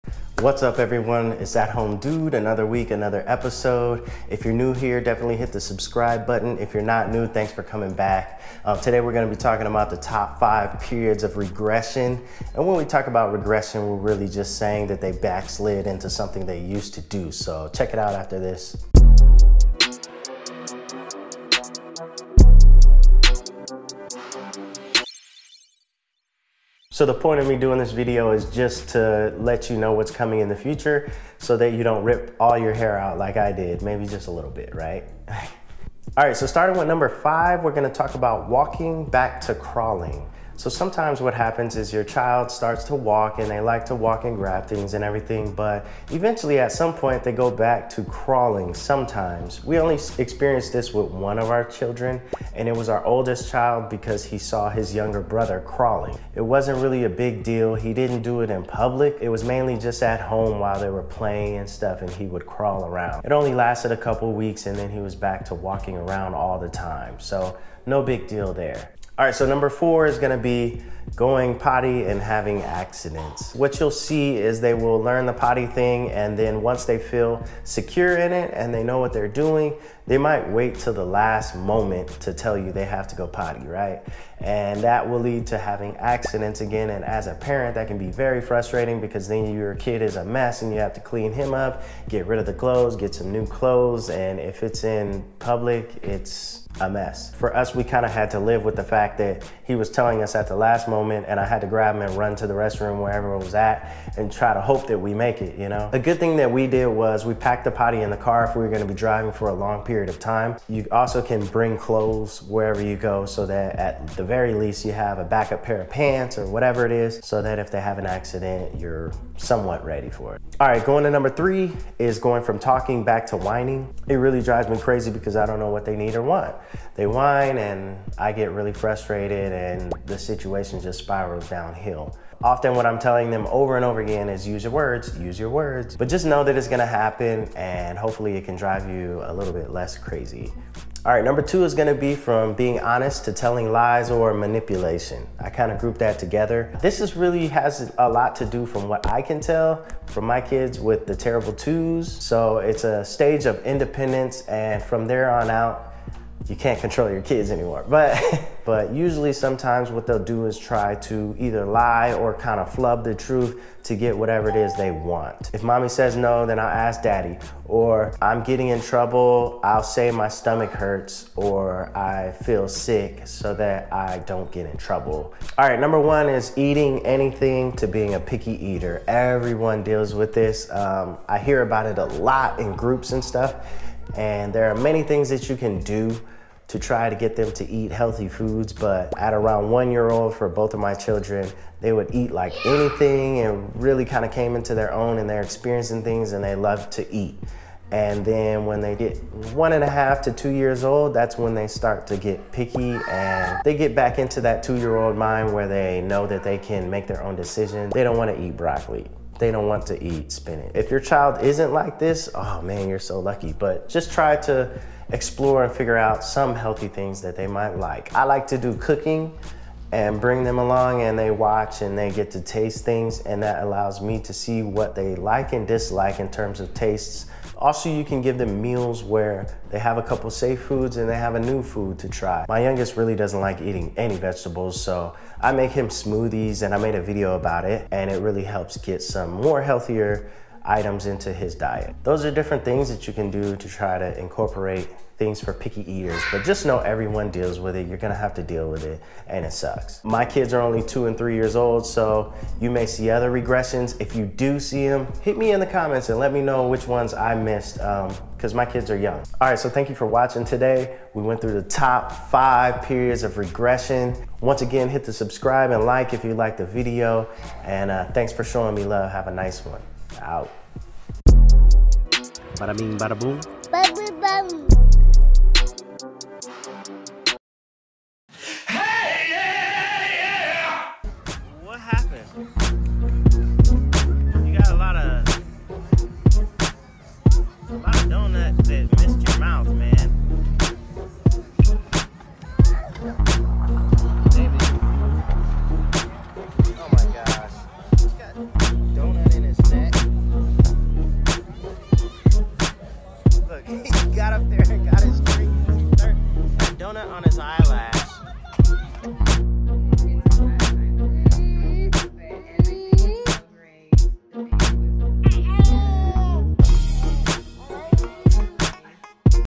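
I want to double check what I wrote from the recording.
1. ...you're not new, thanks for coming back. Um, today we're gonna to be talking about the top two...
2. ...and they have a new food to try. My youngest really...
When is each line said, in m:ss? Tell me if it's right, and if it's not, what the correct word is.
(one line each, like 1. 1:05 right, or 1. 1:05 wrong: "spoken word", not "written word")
1. 0:06 wrong: "five", not "two"
2. 3:50 right.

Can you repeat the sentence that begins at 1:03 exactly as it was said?
It only lasted a couple weeks and then he was back to walking around all the time.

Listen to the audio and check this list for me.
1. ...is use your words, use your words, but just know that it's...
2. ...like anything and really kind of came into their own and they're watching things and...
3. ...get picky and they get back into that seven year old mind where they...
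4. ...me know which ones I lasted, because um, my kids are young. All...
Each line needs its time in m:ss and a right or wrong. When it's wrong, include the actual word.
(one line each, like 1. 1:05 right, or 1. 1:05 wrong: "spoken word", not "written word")
1. 2:14 right
2. 3:12 wrong: "experiencing", not "watching"
3. 3:22 wrong: "two", not "seven"
4. 4:16 wrong: "missed", not "lasted".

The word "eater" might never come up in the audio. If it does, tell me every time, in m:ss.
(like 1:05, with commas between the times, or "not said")
2:58, 4:05.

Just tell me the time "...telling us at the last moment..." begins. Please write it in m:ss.
1:39.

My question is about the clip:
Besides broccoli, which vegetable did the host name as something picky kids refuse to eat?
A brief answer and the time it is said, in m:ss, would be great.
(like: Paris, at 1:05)
Spinach, at 3:30.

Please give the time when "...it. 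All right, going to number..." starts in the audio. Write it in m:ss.
2:00.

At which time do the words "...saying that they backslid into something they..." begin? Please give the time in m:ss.
0:14.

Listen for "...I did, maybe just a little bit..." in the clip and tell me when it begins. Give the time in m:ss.
0:33.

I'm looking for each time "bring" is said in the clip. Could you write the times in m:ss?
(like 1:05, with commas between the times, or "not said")
1:51, 3:40.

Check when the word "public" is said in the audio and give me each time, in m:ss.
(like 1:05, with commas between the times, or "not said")
0:58, 1:35.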